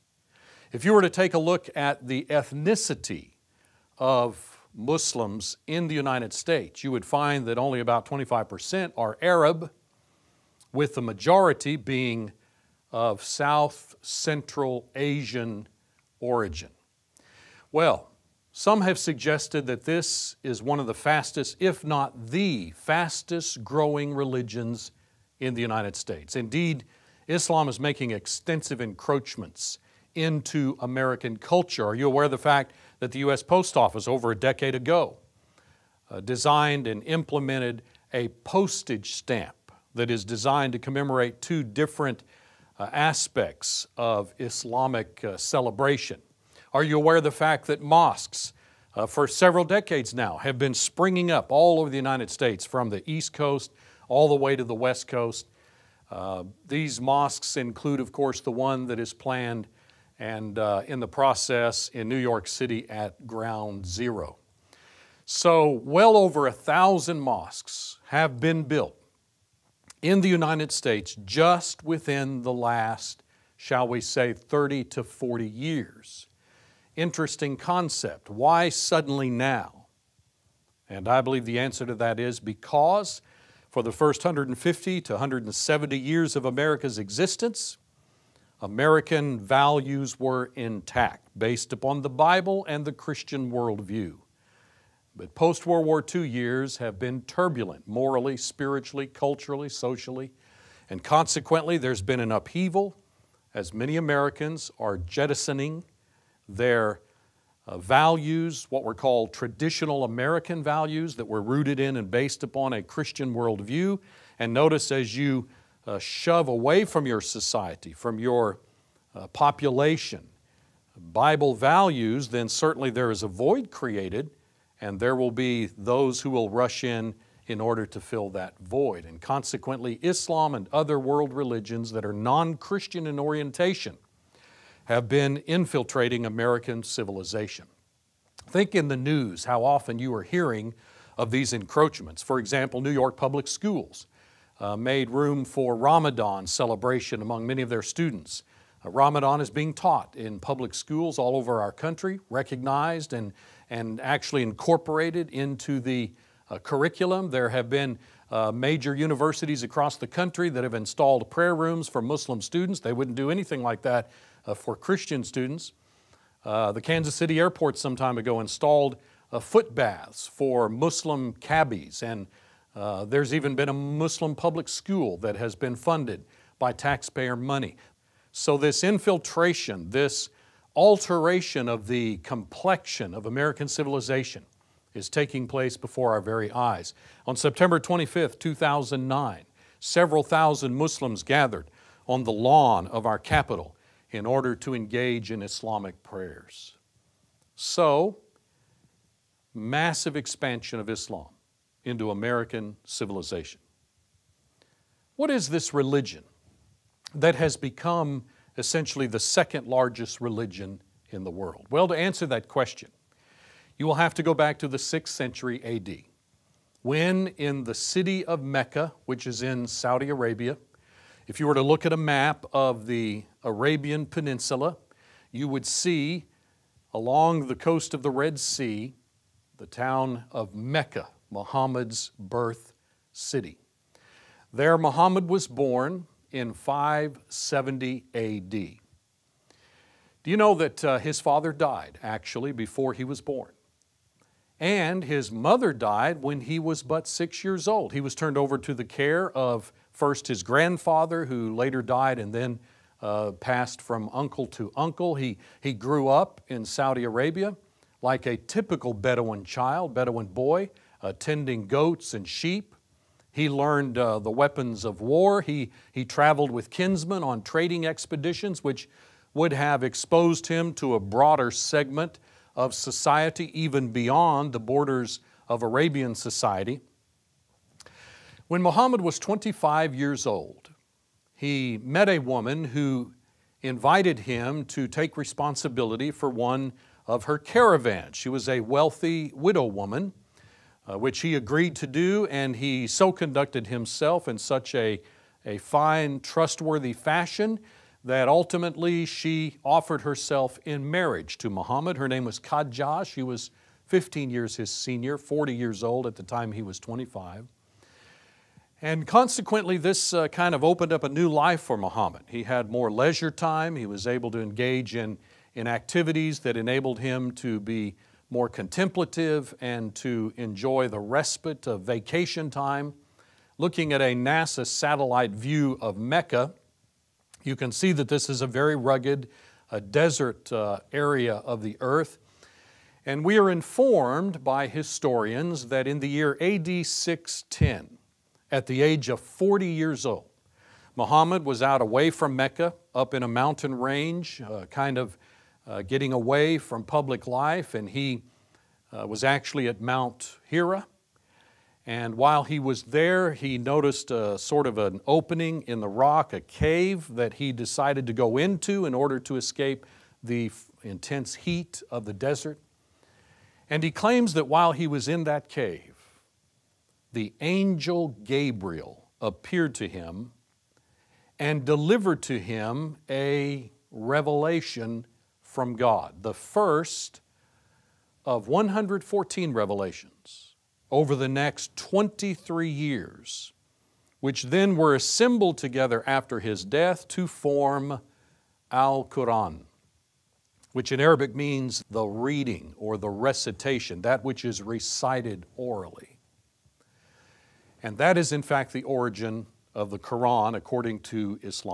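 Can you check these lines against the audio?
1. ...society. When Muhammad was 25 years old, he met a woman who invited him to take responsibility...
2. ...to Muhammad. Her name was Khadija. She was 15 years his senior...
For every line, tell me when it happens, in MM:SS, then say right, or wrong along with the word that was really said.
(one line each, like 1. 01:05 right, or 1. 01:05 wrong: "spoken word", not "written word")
1. 04:36 right
2. 05:01 right.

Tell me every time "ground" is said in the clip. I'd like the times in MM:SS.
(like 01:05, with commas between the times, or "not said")
01:03.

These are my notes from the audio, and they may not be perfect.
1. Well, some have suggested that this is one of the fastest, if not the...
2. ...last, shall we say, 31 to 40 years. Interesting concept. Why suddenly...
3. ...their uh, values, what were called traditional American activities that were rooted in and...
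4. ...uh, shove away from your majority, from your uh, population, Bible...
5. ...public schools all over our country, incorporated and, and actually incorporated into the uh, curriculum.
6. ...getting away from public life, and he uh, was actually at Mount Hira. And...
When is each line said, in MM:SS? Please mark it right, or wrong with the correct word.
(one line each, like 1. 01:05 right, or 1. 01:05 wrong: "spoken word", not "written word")
1. 00:17 right
2. 01:12 wrong: "30", not "31"
3. 01:46 wrong: "values", not "activities"
4. 01:55 wrong: "society", not "majority"
5. 02:30 wrong: "recognized", not "incorporated"
6. 05:45 right.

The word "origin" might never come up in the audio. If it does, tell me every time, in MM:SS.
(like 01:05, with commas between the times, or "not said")
00:16, 06:38.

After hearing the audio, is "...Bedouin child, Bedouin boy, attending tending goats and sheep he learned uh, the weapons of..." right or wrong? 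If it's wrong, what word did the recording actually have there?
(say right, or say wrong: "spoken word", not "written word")
right.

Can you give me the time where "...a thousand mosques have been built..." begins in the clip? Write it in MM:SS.
01:06.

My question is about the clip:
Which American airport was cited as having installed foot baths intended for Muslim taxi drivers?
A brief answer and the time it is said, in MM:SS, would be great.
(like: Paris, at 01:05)
Kansas City airport, at 02:46.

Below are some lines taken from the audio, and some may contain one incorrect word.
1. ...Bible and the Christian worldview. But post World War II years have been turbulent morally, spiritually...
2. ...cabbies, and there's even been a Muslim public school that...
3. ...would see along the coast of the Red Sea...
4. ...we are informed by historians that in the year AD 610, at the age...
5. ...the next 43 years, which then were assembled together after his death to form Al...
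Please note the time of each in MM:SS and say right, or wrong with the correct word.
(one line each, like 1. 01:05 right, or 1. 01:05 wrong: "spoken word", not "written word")
1. 01:32 right
2. 02:51 right
3. 03:45 right
4. 05:33 right
5. 06:21 wrong: "23", not "43".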